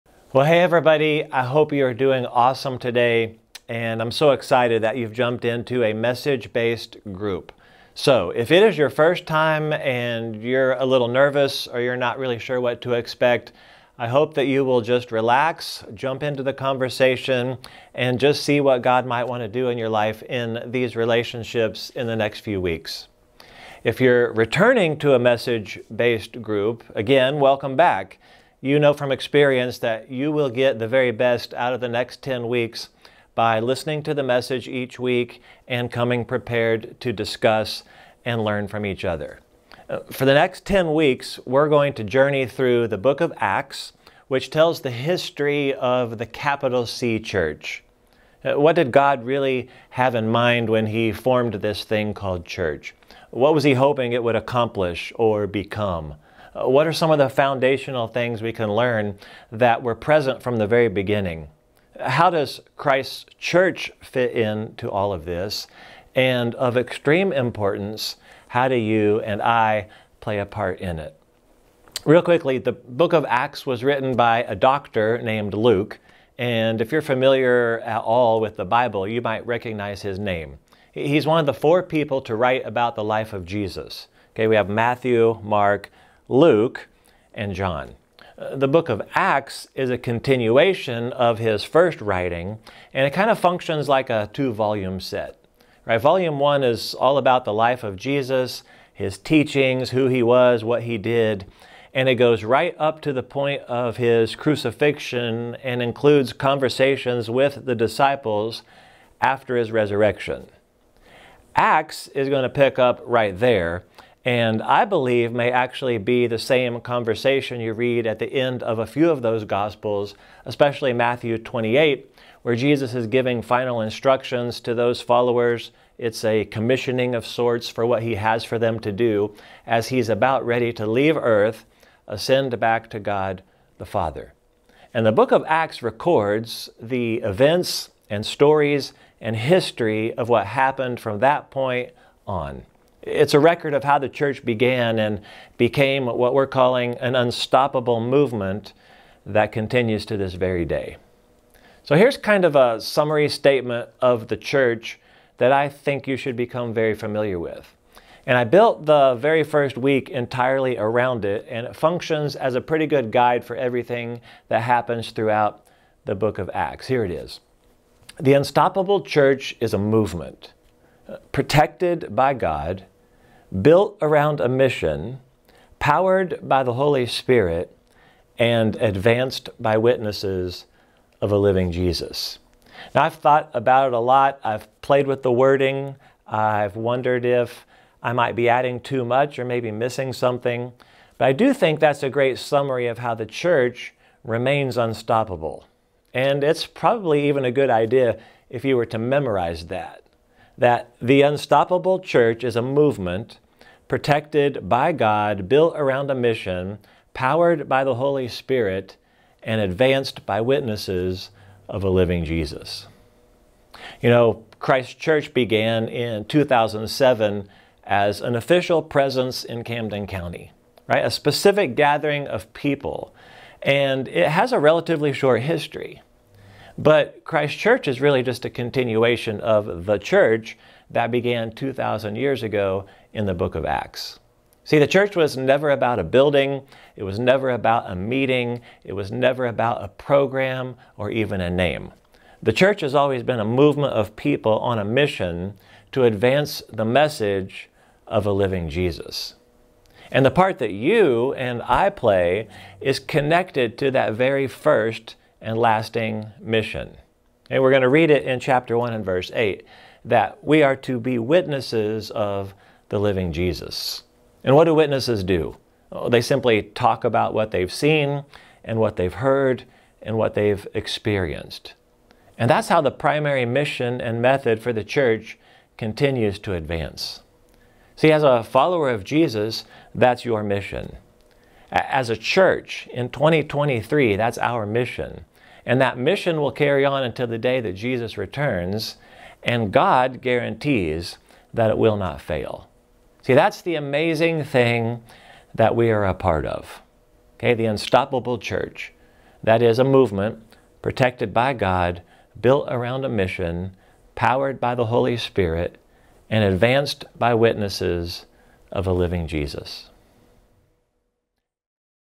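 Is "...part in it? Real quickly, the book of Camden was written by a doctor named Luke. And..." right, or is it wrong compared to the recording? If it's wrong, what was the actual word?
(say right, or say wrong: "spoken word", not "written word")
wrong: "Acts", not "Camden".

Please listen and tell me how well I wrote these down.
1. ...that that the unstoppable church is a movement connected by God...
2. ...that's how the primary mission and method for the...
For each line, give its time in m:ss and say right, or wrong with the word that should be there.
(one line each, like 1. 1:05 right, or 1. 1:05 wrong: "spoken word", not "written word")
1. 3:19 wrong: "protected", not "connected"
2. 4:32 right.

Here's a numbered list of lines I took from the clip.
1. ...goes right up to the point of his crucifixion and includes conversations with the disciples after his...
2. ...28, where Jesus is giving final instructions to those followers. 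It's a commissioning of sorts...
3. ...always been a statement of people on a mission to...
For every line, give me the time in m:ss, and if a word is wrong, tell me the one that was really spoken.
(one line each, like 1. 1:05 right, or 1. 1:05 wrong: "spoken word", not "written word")
1. 1:42 right
2. 2:01 right
3. 4:02 wrong: "movement", not "statement".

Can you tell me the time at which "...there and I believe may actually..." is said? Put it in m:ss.
1:53.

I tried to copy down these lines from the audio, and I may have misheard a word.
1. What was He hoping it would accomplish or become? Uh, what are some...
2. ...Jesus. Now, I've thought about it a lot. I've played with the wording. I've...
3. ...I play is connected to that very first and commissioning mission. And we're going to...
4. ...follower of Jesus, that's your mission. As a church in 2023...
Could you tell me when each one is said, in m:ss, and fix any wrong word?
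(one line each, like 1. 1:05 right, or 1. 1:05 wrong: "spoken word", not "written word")
1. 0:53 right
2. 3:01 right
3. 4:11 wrong: "lasting", not "commissioning"
4. 4:38 right.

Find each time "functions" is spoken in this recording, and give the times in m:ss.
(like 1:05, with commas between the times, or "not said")
1:33, 2:41.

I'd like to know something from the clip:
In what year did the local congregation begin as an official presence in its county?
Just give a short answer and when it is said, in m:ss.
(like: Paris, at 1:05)
2007, at 3:36.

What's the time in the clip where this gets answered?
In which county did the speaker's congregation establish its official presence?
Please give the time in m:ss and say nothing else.
3:39.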